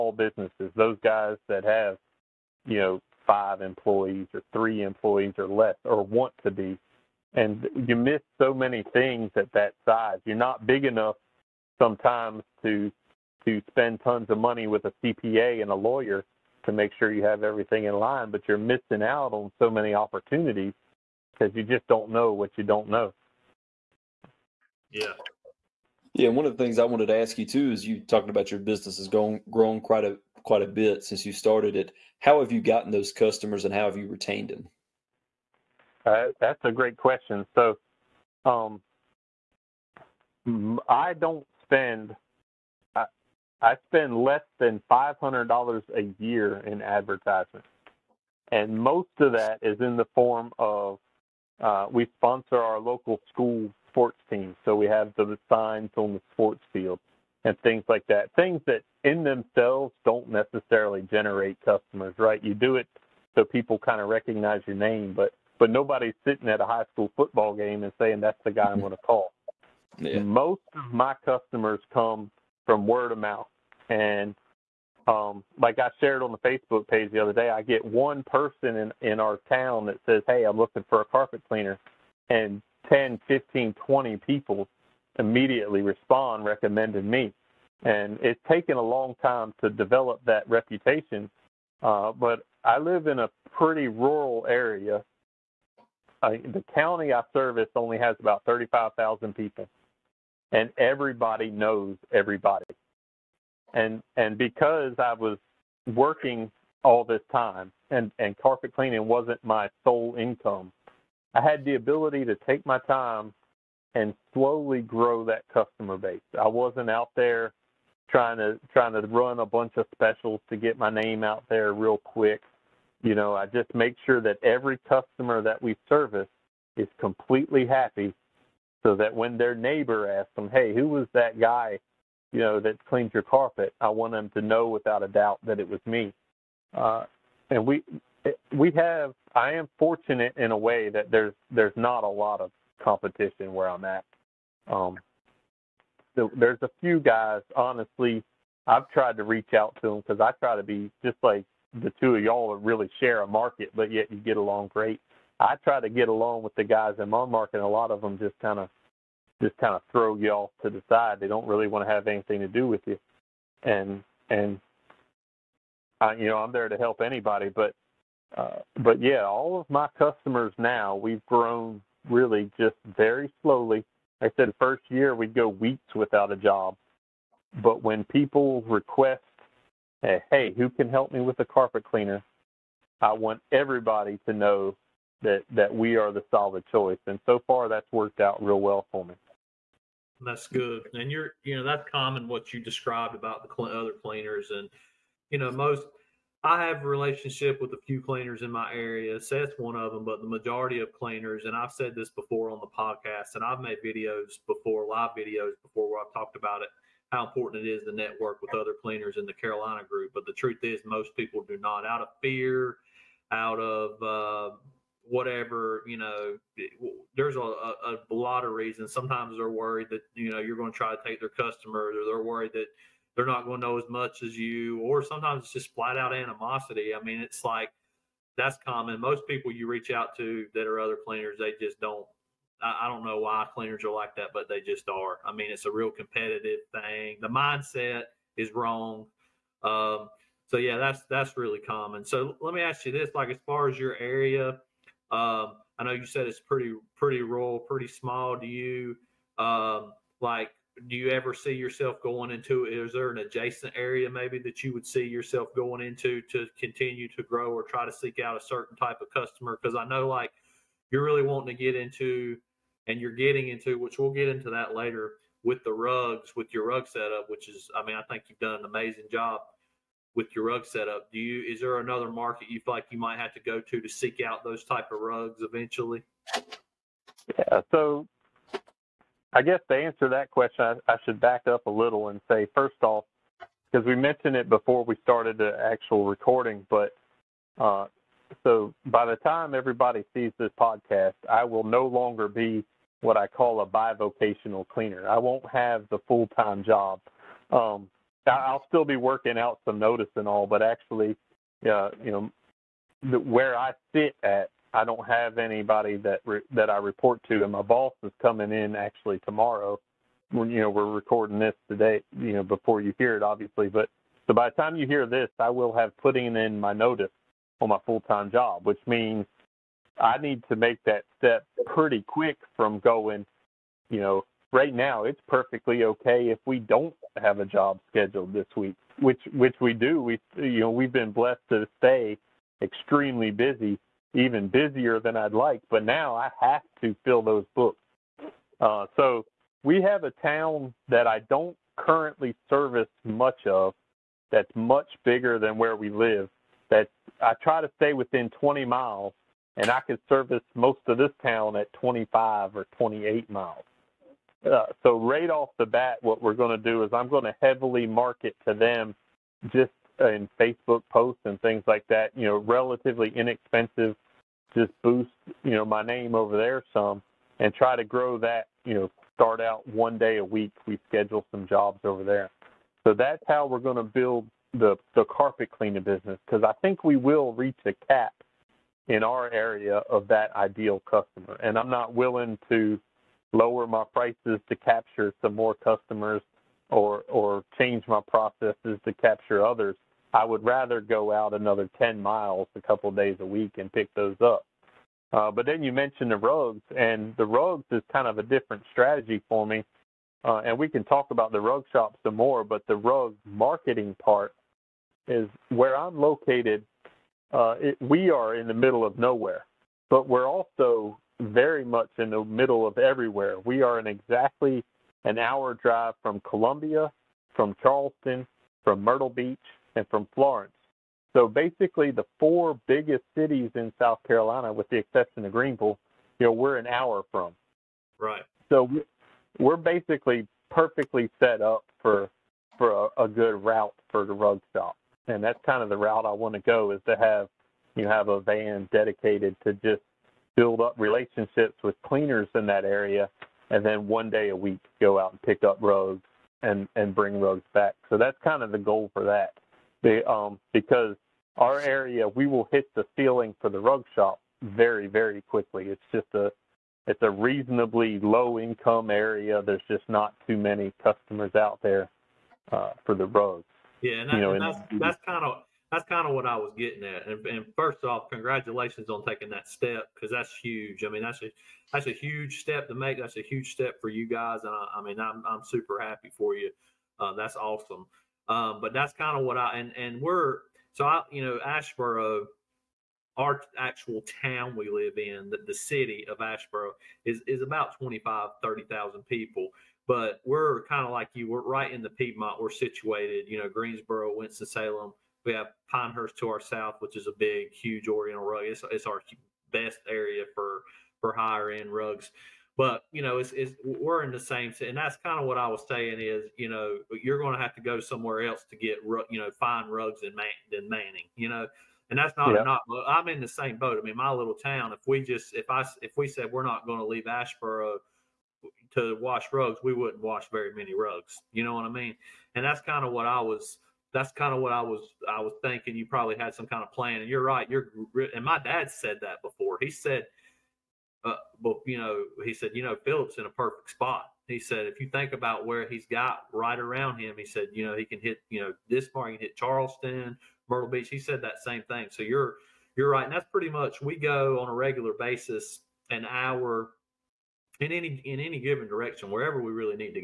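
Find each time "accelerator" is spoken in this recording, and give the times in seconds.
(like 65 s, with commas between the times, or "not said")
not said.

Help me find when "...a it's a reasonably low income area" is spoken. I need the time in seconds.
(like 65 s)
456 s.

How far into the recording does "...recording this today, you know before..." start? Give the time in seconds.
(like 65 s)
310 s.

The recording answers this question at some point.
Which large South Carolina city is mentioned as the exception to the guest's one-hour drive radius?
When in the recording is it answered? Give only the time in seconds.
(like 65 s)
425 s.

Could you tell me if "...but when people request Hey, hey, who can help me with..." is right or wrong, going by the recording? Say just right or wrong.
right.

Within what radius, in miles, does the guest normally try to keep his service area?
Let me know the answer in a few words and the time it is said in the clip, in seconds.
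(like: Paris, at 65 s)
20 miles, at 348 s.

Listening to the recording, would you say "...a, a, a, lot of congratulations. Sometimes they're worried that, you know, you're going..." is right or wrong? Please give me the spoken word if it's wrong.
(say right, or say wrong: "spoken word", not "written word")
wrong: "reasons", not "congratulations".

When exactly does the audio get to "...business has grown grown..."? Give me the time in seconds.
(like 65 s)
28 s.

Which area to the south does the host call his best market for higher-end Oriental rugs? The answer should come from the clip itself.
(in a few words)
Pinehurst.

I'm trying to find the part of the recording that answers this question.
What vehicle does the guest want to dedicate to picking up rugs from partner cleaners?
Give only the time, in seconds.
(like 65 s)
438 s.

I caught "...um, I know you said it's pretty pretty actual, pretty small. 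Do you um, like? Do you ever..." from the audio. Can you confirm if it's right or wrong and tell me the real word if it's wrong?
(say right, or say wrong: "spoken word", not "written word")
wrong: "rural", not "actual".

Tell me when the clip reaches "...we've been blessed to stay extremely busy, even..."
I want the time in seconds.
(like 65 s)
330 s.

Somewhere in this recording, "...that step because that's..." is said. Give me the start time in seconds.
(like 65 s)
469 s.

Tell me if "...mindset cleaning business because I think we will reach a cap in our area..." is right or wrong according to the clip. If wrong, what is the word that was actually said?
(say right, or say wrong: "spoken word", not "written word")
wrong: "carpet", not "mindset".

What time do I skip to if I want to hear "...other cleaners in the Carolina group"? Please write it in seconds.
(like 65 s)
208 s.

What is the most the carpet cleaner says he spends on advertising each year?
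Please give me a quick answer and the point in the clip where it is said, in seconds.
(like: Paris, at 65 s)
$500, at 44 s.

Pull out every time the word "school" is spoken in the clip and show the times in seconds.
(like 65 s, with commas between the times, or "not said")
53 s, 66 s.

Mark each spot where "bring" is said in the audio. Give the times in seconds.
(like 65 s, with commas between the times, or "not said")
446 s.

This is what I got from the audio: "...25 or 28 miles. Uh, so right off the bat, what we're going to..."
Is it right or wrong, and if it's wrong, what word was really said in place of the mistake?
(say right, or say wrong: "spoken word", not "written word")
right.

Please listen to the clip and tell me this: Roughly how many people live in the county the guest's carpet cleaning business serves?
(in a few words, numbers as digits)
35,000.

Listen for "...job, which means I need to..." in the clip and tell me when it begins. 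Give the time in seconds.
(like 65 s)
318 s.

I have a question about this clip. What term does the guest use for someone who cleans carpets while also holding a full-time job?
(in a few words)
bivocational cleaner.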